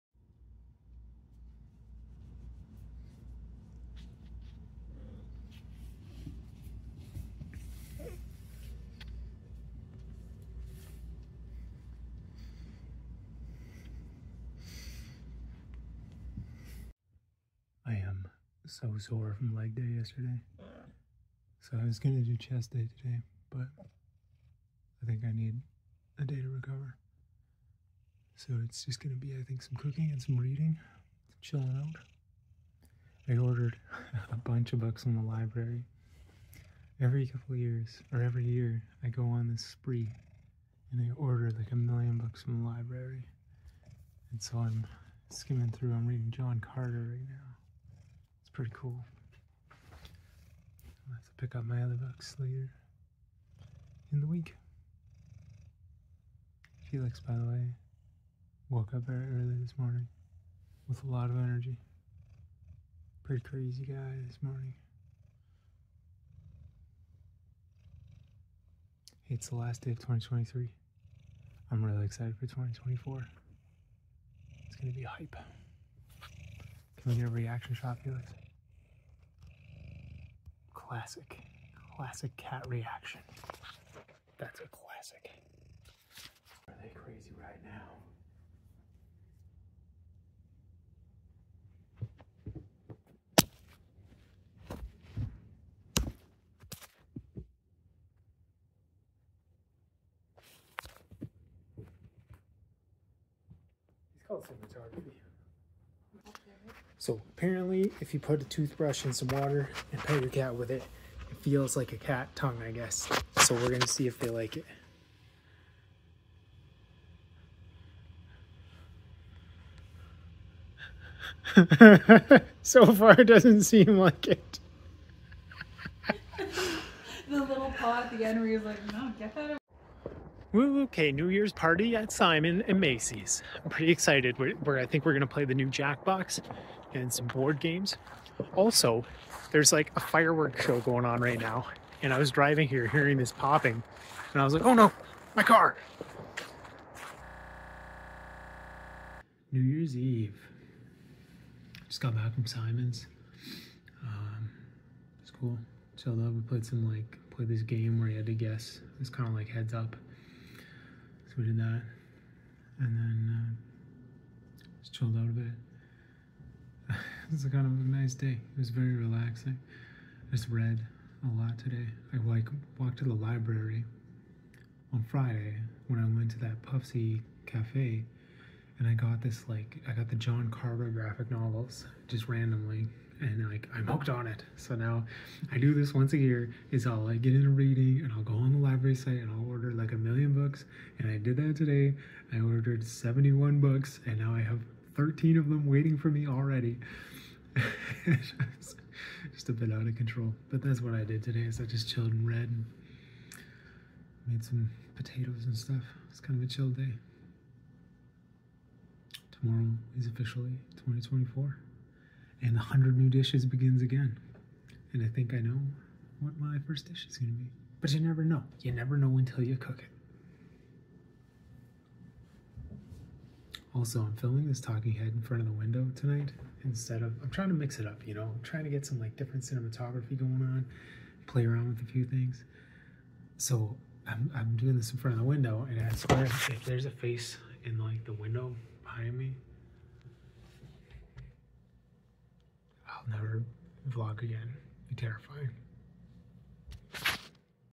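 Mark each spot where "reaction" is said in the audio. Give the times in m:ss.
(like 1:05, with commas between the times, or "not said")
1:17, 1:22.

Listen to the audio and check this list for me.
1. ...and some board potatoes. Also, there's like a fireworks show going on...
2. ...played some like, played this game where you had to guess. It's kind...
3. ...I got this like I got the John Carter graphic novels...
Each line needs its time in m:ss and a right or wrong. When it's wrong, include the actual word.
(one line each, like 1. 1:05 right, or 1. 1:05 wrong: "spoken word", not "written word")
1. 2:16 wrong: "games", not "potatoes"
2. 2:36 right
3. 2:58 right.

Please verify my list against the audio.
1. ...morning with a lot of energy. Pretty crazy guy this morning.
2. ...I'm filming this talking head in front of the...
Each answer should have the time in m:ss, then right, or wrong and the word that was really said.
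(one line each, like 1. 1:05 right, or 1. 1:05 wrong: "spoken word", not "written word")
1. 0:59 right
2. 3:44 right.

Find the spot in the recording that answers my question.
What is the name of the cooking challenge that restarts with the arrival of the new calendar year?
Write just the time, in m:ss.
3:32.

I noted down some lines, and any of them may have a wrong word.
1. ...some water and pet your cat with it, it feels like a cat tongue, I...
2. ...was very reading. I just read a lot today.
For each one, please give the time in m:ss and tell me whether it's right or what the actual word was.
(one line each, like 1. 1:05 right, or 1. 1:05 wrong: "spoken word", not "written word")
1. 1:49 right
2. 2:48 wrong: "relaxing", not "reading".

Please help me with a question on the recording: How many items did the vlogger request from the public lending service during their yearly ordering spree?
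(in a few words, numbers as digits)
71.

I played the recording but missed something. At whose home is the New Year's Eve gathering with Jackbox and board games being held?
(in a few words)
Simon and Mayce's.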